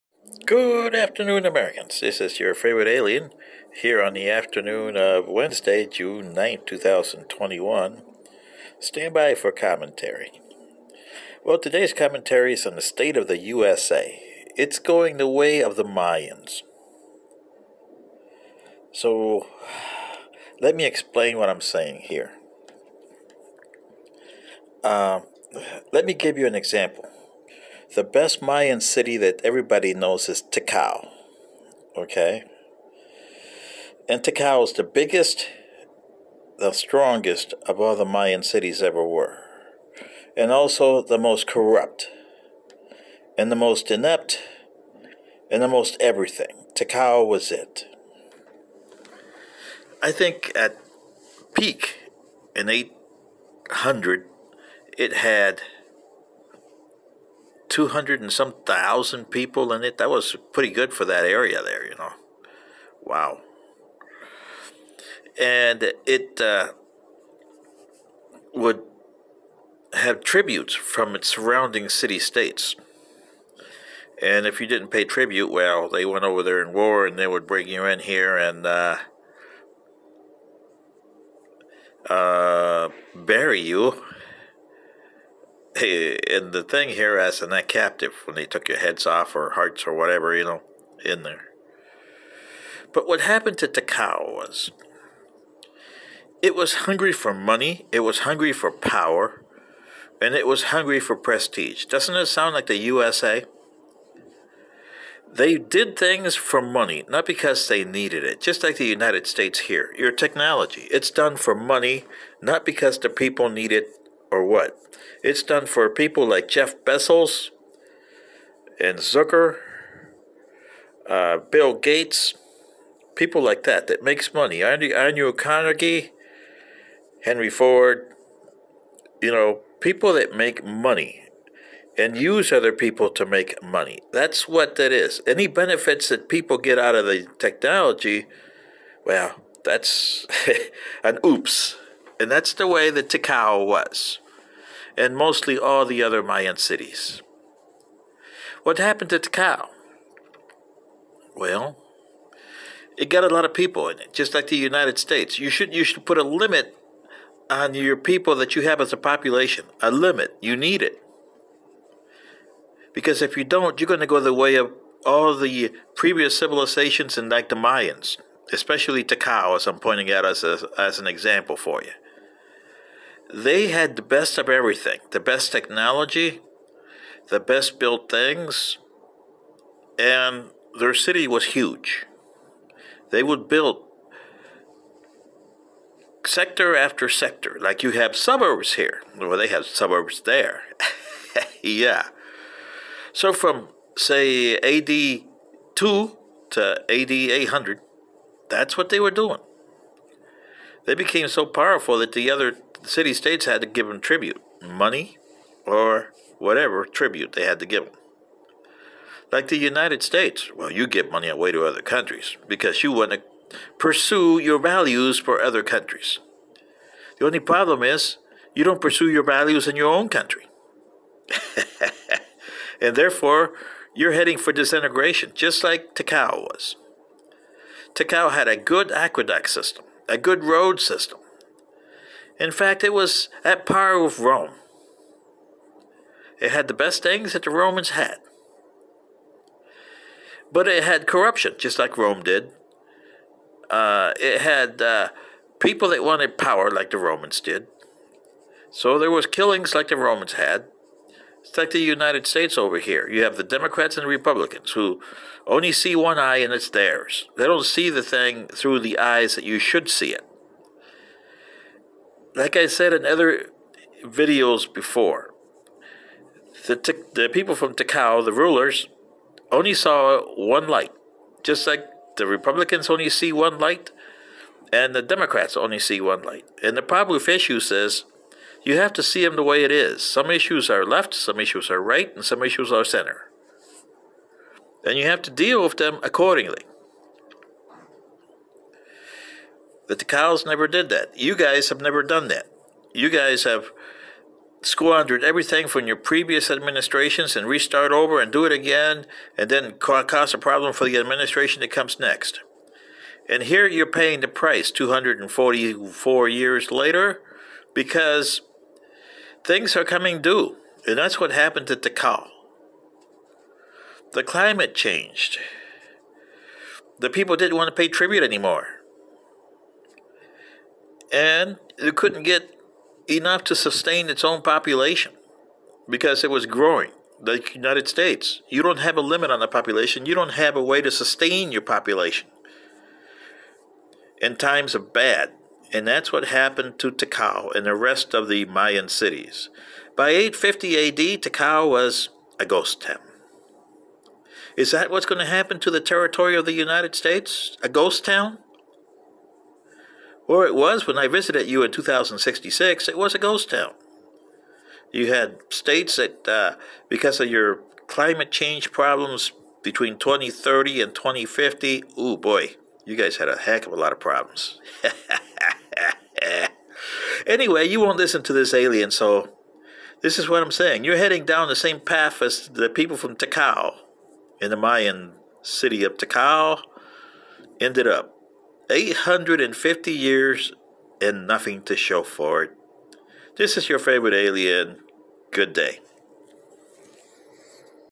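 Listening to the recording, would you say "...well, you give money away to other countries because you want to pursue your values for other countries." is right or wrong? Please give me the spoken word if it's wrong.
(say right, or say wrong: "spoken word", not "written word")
right.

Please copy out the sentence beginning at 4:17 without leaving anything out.
They don't see the thing through the eyes that you should see it.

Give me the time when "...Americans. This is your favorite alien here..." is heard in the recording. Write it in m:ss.
0:01.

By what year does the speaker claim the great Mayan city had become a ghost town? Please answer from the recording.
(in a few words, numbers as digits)
850 AD.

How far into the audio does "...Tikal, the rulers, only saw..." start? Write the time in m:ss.
4:27.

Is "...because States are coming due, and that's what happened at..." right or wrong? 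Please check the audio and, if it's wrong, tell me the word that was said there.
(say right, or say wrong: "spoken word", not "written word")
wrong: "Things", not "States".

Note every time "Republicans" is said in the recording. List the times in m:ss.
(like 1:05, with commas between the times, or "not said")
4:14, 4:32.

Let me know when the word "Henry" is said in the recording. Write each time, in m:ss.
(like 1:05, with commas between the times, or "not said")
2:07.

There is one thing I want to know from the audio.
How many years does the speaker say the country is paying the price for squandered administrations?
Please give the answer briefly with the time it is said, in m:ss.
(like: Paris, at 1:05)
244, at 5:04.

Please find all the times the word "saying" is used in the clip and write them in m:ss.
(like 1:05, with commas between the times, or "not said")
0:21, 6:10.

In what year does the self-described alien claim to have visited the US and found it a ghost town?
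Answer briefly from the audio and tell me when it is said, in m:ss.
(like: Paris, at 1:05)
2066, at 5:51.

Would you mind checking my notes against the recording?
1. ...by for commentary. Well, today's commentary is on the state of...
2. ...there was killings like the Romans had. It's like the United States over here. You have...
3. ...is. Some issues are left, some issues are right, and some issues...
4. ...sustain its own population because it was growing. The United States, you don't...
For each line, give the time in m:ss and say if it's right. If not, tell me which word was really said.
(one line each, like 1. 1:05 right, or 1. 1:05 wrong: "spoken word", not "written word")
1. 0:09 right
2. 4:08 right
3. 4:39 right
4. 5:23 right.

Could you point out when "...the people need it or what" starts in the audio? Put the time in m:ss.
1:52.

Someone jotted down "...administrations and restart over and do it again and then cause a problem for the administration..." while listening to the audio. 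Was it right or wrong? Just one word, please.
right.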